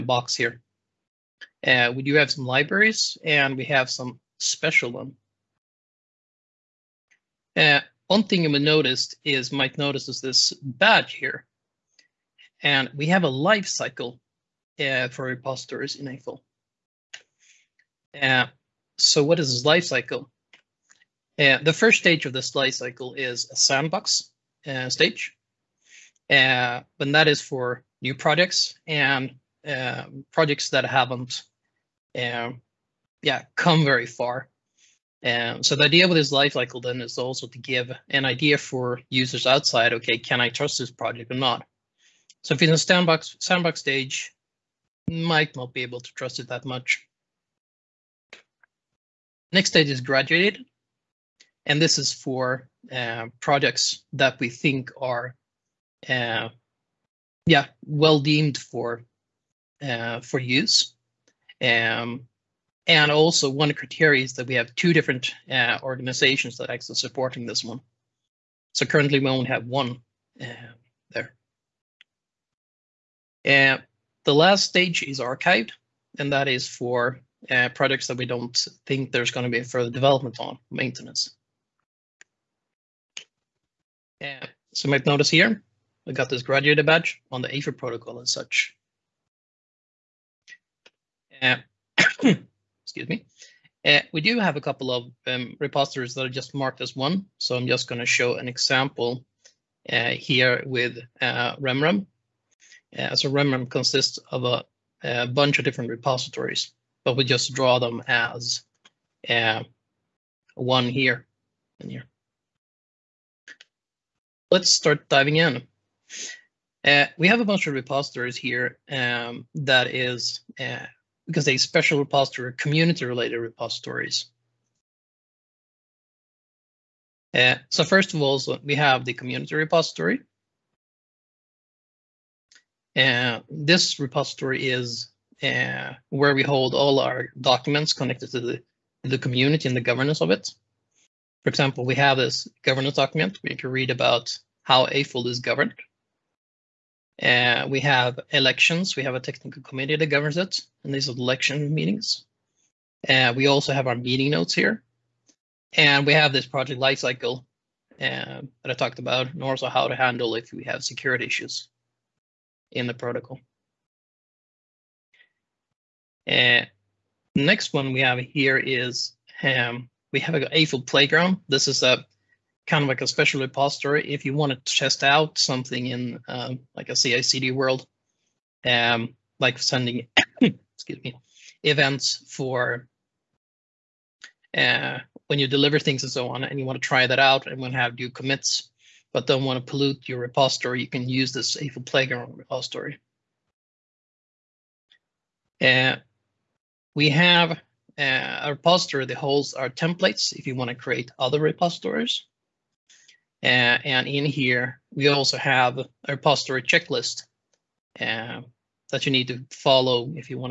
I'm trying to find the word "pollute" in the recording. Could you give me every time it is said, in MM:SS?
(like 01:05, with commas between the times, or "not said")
03:09.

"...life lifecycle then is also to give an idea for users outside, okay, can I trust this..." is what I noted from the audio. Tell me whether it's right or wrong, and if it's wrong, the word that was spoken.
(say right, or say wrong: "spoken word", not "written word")
wrong: "cycle", not "lifecycle".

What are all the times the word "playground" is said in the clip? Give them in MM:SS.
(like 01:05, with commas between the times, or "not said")
02:50, 03:11.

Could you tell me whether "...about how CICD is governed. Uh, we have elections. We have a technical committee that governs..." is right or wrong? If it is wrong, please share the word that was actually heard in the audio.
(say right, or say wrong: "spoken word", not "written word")
wrong: "Eiffel", not "CICD".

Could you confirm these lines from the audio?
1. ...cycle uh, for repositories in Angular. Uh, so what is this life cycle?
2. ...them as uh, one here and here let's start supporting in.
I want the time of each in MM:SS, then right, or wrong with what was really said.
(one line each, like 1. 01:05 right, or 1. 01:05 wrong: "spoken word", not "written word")
1. 00:13 right
2. 01:47 wrong: "diving", not "supporting".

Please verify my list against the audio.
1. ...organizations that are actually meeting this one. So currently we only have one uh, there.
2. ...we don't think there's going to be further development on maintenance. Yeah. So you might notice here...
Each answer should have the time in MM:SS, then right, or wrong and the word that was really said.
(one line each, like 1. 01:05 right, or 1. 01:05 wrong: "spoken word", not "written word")
1. 01:05 wrong: "supporting", not "meeting"
2. 01:18 right.